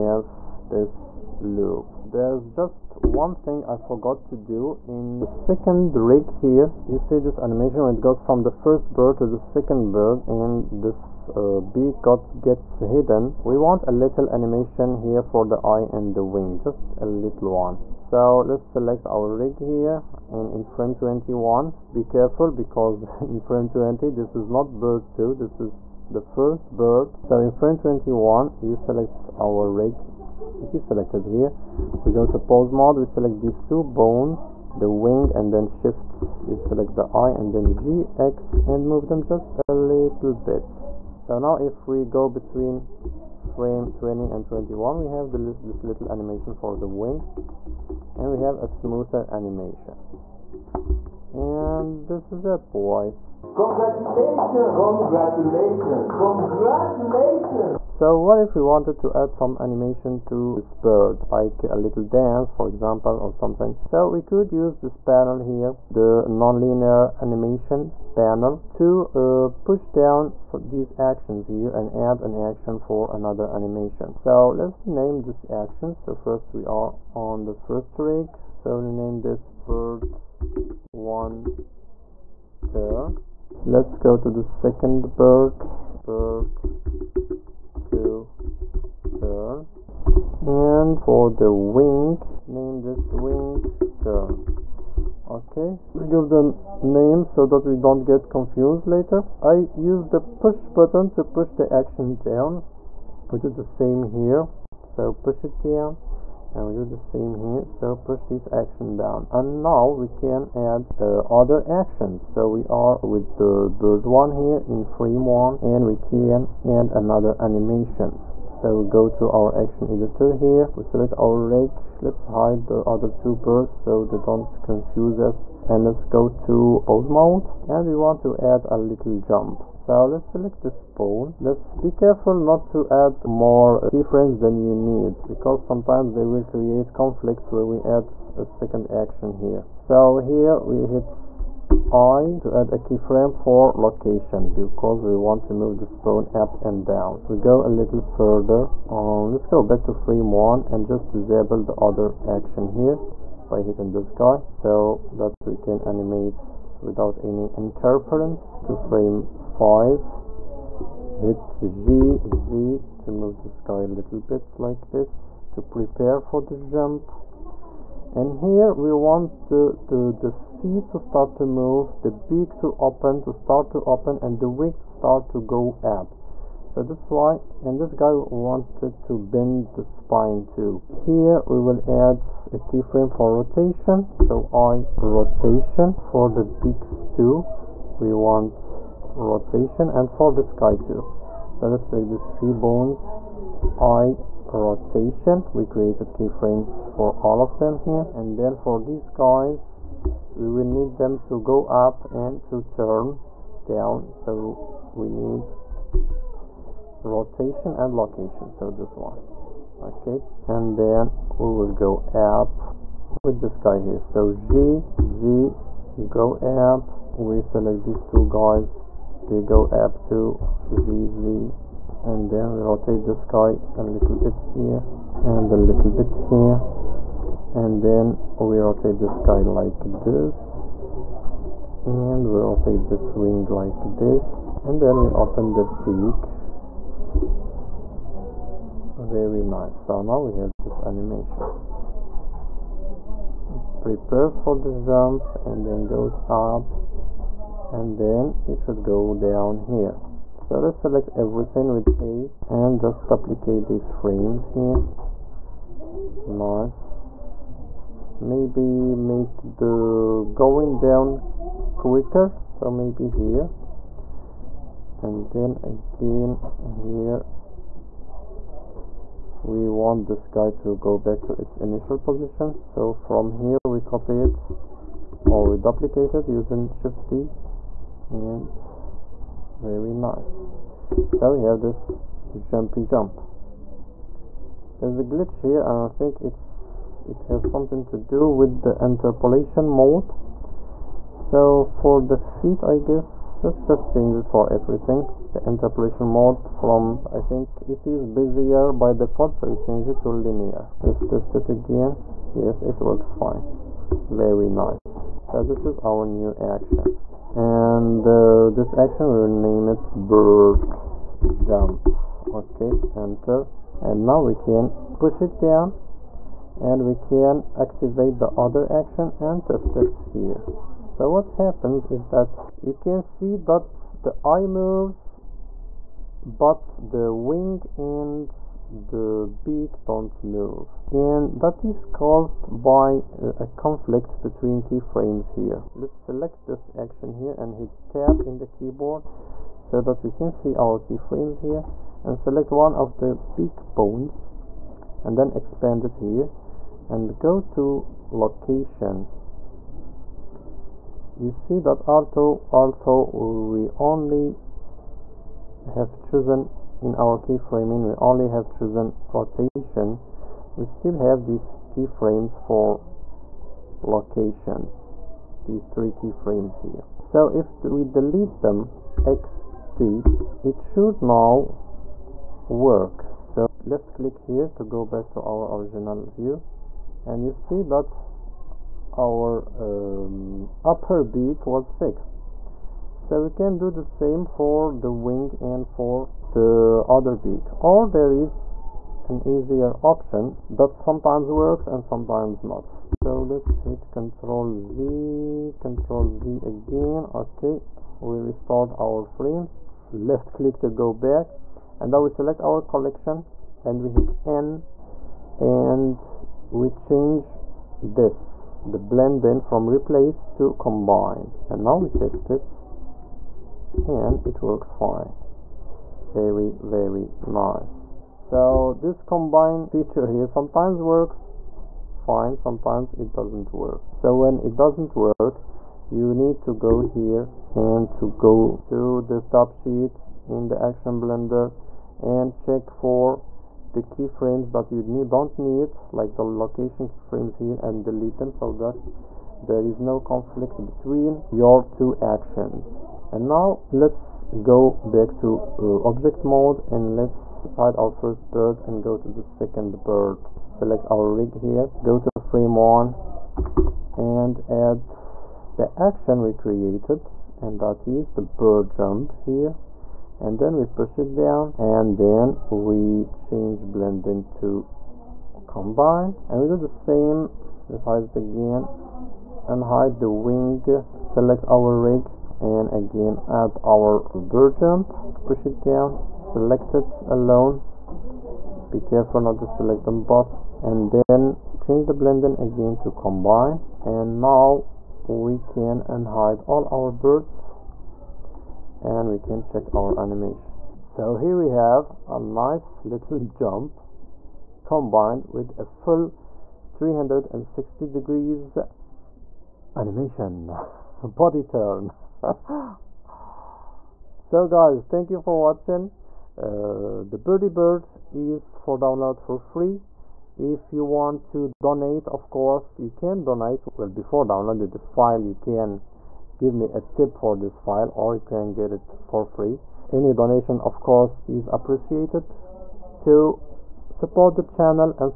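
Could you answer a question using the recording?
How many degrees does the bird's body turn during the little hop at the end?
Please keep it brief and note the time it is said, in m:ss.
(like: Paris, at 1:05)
360, at 8:16.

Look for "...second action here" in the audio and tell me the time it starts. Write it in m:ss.
2:18.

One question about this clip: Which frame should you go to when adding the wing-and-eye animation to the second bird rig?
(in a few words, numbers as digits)
21.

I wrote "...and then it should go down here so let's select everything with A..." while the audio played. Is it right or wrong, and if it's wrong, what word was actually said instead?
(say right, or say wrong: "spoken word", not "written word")
right.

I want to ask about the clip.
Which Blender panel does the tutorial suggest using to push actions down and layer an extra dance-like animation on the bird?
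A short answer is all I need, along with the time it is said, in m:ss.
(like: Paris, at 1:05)
nonlinear animation panel, at 1:05.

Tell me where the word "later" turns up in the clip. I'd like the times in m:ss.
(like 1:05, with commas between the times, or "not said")
1:38.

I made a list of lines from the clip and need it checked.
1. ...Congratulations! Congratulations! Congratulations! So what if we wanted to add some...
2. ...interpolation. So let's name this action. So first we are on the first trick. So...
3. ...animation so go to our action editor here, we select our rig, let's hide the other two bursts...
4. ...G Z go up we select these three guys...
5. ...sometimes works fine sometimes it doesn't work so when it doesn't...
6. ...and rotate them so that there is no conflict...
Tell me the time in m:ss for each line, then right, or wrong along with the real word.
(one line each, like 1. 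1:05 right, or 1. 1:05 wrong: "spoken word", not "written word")
1. 0:53 right
2. 1:13 wrong: "animation", not "interpolation"
3. 1:57 right
4. 3:34 wrong: "two", not "three"
5. 7:00 right
6. 7:17 wrong: "delete", not "rotate".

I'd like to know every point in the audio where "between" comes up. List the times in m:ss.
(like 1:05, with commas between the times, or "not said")
0:42, 5:34, 7:20.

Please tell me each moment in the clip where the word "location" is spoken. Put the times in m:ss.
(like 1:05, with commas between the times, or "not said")
2:23, 3:27, 5:48, 6:03, 7:16.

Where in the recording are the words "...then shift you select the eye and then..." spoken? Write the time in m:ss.
0:35.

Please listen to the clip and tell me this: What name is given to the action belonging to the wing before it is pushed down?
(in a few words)
wing turn.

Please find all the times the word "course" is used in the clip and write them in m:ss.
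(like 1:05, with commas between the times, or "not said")
8:32, 8:40.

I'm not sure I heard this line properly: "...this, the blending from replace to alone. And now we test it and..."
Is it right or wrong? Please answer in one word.
wrong.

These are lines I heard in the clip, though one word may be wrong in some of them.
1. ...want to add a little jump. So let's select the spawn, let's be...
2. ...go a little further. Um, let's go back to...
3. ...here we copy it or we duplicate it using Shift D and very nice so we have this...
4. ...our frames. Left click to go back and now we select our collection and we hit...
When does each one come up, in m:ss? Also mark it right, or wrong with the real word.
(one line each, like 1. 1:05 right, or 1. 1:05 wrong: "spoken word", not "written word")
1. 2:07 right
2. 2:27 right
3. 4:33 right
4. 6:38 right.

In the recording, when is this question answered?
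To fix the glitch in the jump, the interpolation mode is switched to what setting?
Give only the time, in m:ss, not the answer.
5:00.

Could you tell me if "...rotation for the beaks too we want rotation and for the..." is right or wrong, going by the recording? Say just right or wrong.
right.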